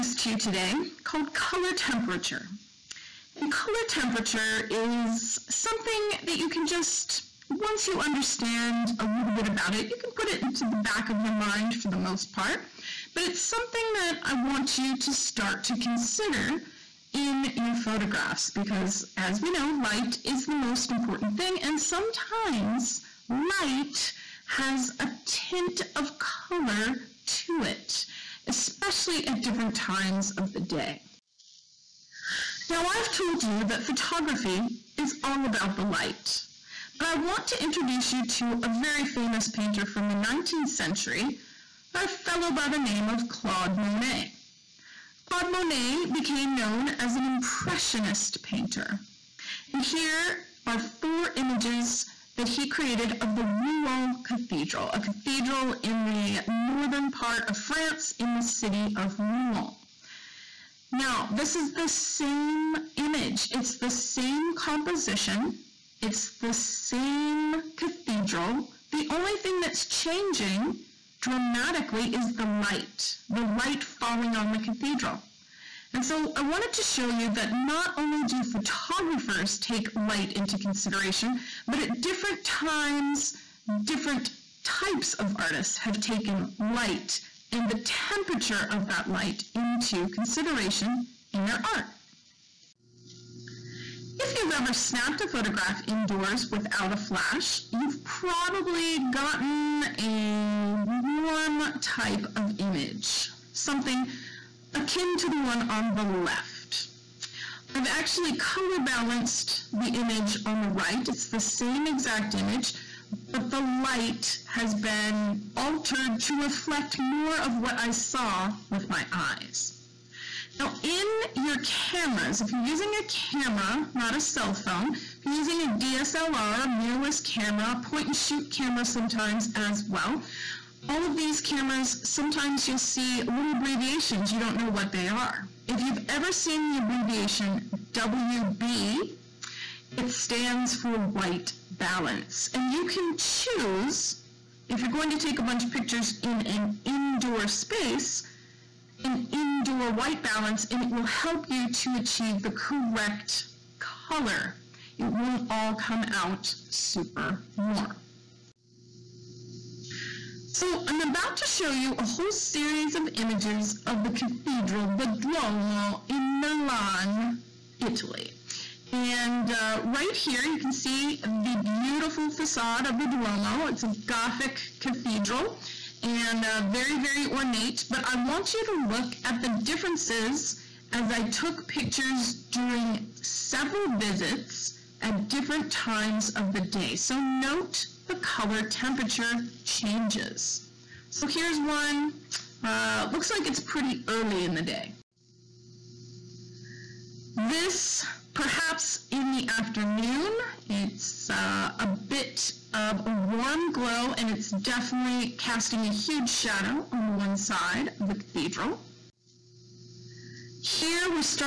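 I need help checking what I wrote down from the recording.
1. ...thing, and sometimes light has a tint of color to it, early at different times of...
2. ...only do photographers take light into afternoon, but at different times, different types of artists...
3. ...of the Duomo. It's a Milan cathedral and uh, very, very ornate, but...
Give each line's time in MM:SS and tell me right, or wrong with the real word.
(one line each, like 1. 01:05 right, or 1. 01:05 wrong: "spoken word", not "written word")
1. 00:21 wrong: "especially", not "early"
2. 01:17 wrong: "consideration", not "afternoon"
3. 02:52 wrong: "Gothic", not "Milan".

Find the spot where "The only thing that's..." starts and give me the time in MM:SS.
01:08.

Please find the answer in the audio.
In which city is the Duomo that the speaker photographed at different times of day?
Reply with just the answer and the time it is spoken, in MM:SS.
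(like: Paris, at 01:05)
Milan, at 02:46.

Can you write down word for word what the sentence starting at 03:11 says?
So here's one, uh, looks like it's pretty early in the day.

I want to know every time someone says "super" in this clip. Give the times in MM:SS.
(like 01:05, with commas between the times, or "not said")
02:36.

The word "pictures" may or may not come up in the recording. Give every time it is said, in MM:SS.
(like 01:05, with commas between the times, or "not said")
02:25, 03:01.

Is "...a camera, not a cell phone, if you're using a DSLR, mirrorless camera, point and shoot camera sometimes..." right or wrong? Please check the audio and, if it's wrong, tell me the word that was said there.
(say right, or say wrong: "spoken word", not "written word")
right.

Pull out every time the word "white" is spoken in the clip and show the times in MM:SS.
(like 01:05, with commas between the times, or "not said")
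02:20, 02:29.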